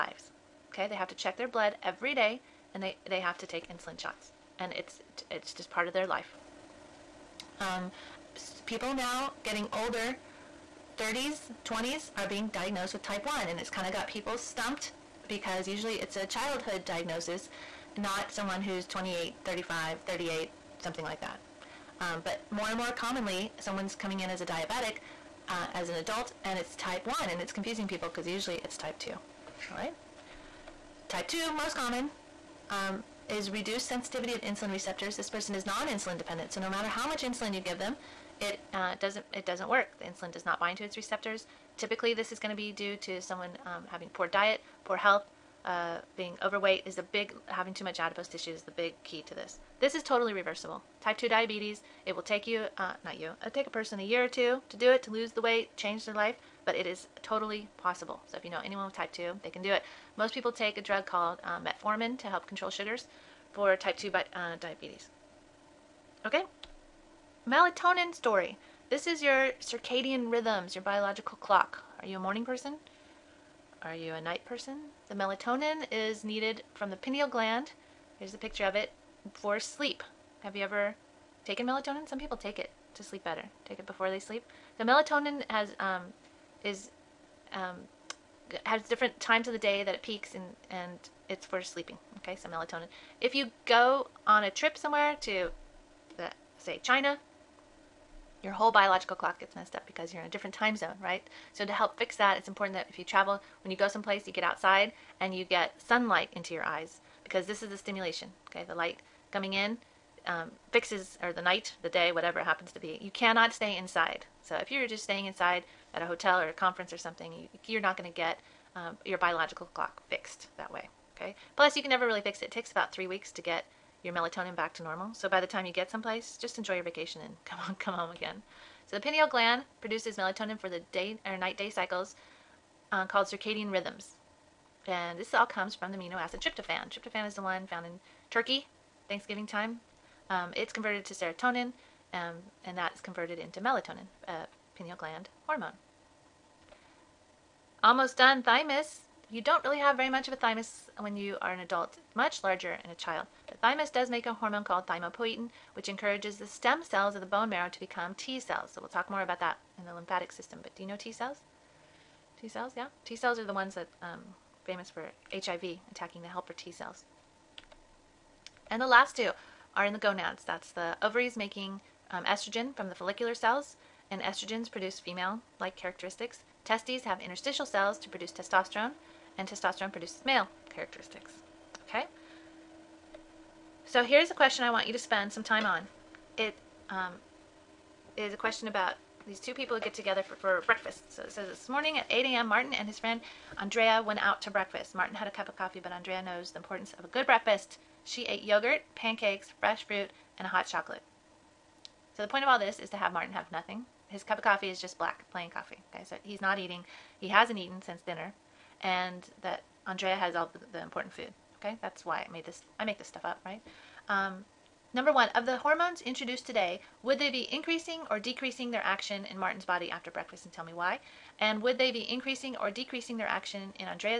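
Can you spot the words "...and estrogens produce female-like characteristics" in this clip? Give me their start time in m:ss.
2:54.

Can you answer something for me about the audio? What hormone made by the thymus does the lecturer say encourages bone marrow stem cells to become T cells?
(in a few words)
Thymopoietin.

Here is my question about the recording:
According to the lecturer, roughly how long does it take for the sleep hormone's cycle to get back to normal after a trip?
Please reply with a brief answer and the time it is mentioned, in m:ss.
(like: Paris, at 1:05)
3 weeks, at 2:02.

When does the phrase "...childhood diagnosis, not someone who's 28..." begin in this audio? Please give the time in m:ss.
0:16.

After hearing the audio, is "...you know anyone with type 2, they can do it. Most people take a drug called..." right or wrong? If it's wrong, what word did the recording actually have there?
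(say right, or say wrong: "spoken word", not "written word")
right.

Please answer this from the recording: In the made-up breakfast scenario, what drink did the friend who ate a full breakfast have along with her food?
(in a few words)
Hot chocolate.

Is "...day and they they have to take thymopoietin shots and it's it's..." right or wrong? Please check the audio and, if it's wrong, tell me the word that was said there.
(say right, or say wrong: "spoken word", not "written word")
wrong: "insulin", not "thymopoietin".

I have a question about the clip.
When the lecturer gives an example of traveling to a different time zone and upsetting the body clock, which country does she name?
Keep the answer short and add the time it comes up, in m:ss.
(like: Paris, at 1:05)
China, at 1:36.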